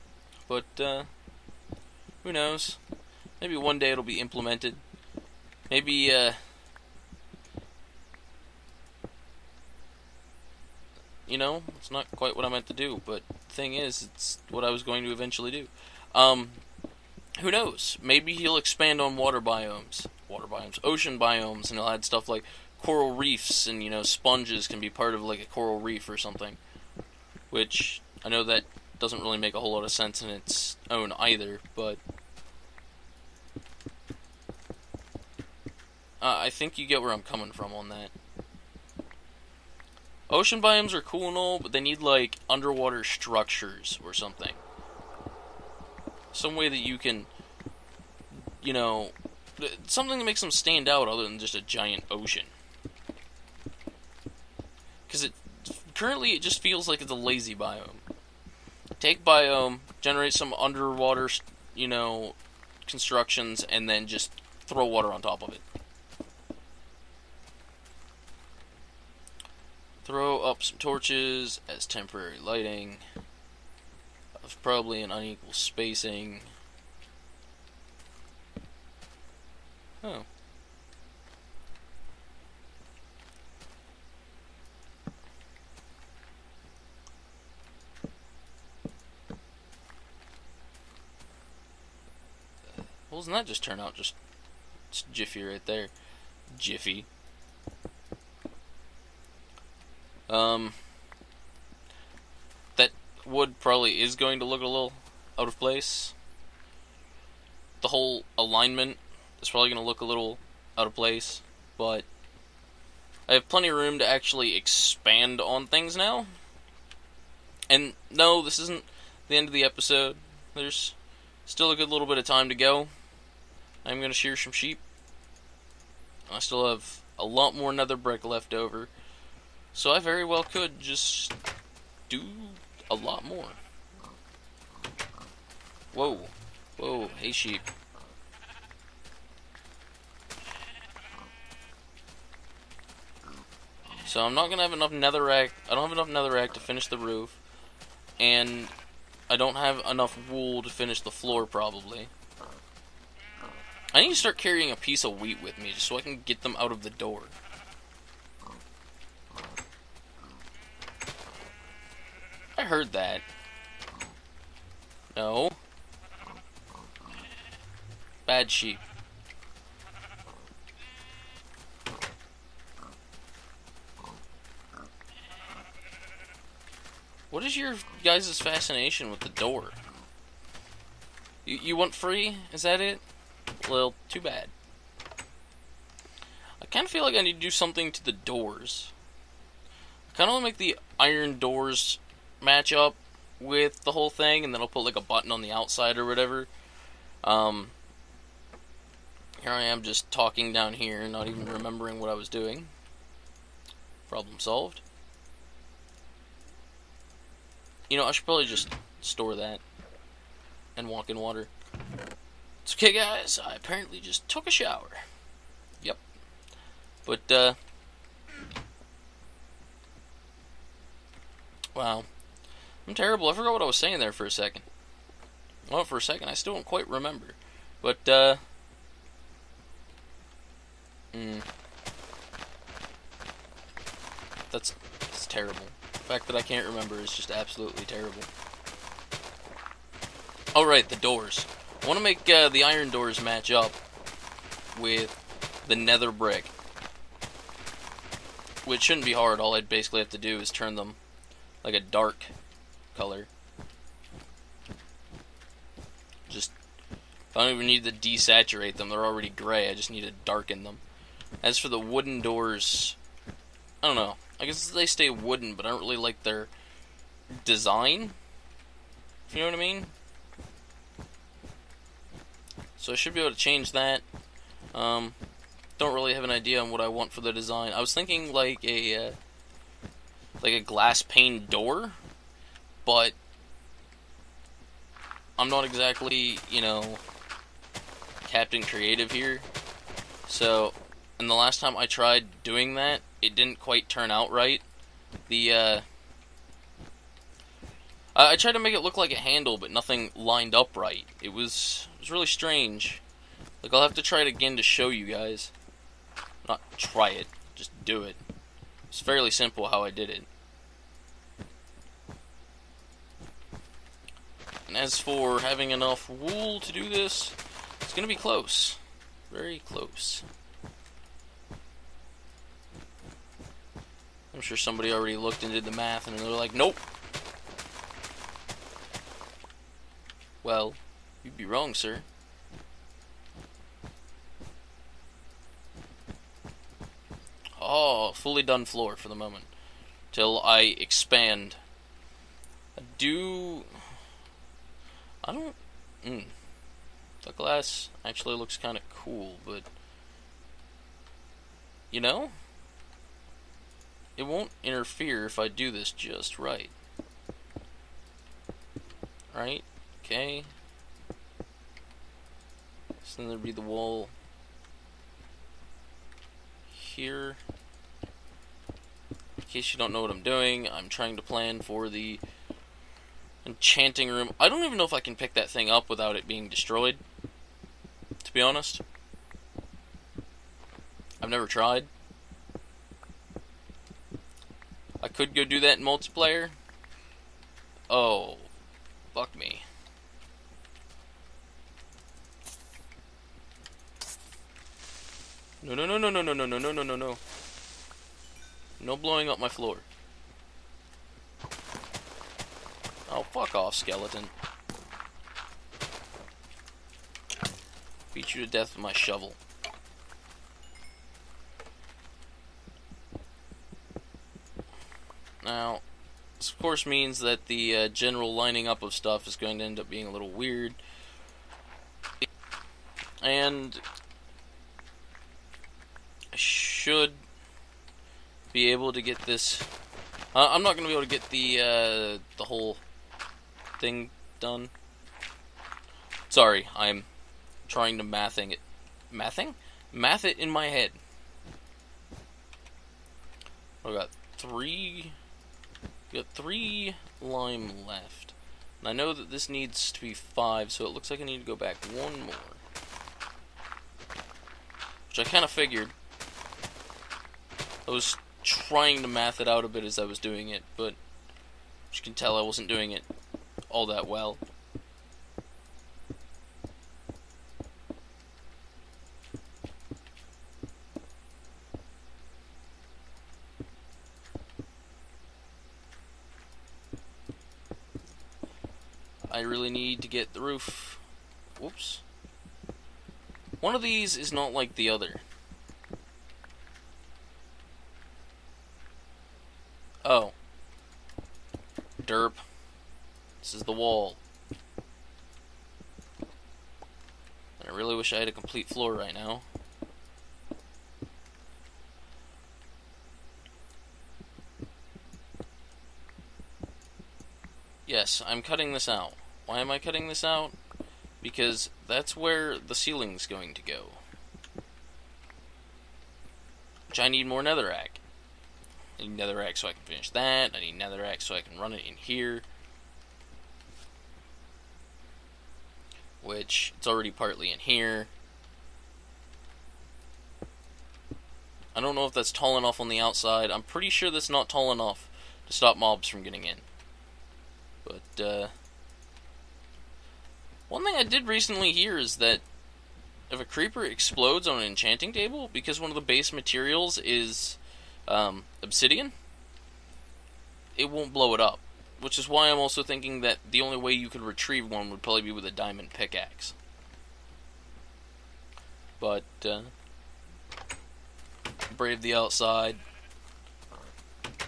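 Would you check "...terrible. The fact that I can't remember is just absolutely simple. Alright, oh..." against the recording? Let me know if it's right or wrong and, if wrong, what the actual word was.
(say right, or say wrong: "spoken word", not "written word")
wrong: "terrible", not "simple".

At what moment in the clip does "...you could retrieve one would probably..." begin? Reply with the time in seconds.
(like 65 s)
553 s.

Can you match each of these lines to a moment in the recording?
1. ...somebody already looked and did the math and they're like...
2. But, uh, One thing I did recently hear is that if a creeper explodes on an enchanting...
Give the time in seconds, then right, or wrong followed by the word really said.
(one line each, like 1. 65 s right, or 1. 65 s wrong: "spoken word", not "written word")
1. 324 s right
2. 537 s right.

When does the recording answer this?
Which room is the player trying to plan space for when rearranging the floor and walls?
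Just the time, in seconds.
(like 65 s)
373 s.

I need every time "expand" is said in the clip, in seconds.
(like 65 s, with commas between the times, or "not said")
18 s, 114 s, 340 s.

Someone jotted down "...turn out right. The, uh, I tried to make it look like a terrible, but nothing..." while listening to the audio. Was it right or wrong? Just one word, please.
wrong.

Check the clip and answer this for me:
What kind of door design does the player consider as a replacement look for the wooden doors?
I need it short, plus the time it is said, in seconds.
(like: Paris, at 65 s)
glass pane door, at 280 s.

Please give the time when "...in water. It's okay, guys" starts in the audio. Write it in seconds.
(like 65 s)
211 s.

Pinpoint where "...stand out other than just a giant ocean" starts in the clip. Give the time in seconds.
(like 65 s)
50 s.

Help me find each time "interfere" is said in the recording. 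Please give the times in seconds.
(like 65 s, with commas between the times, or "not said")
354 s.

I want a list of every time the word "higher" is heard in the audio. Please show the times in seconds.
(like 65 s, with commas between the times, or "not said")
not said.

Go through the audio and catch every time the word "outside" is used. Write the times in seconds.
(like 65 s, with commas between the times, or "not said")
195 s, 533 s, 562 s.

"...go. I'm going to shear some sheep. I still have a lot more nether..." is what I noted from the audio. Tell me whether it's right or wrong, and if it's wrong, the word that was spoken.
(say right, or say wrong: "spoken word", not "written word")
right.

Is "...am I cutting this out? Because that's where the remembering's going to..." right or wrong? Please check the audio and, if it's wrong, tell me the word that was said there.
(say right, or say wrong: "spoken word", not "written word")
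wrong: "ceiling", not "remembering".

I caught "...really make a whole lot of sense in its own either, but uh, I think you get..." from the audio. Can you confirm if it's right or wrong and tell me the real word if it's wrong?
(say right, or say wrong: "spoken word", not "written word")
right.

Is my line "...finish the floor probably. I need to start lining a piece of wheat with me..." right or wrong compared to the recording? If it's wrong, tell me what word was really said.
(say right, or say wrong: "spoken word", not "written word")
wrong: "carrying", not "lining".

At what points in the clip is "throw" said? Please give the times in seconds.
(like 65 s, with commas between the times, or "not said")
64 s, 70 s.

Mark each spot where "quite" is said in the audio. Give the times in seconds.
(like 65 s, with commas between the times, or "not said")
12 s, 226 s, 293 s.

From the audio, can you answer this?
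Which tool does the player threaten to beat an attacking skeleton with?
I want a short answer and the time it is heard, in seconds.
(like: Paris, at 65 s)
shovel, at 408 s.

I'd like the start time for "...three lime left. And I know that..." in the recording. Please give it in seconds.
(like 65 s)
446 s.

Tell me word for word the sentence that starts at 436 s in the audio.
Sorry, I'm trying to mathing it.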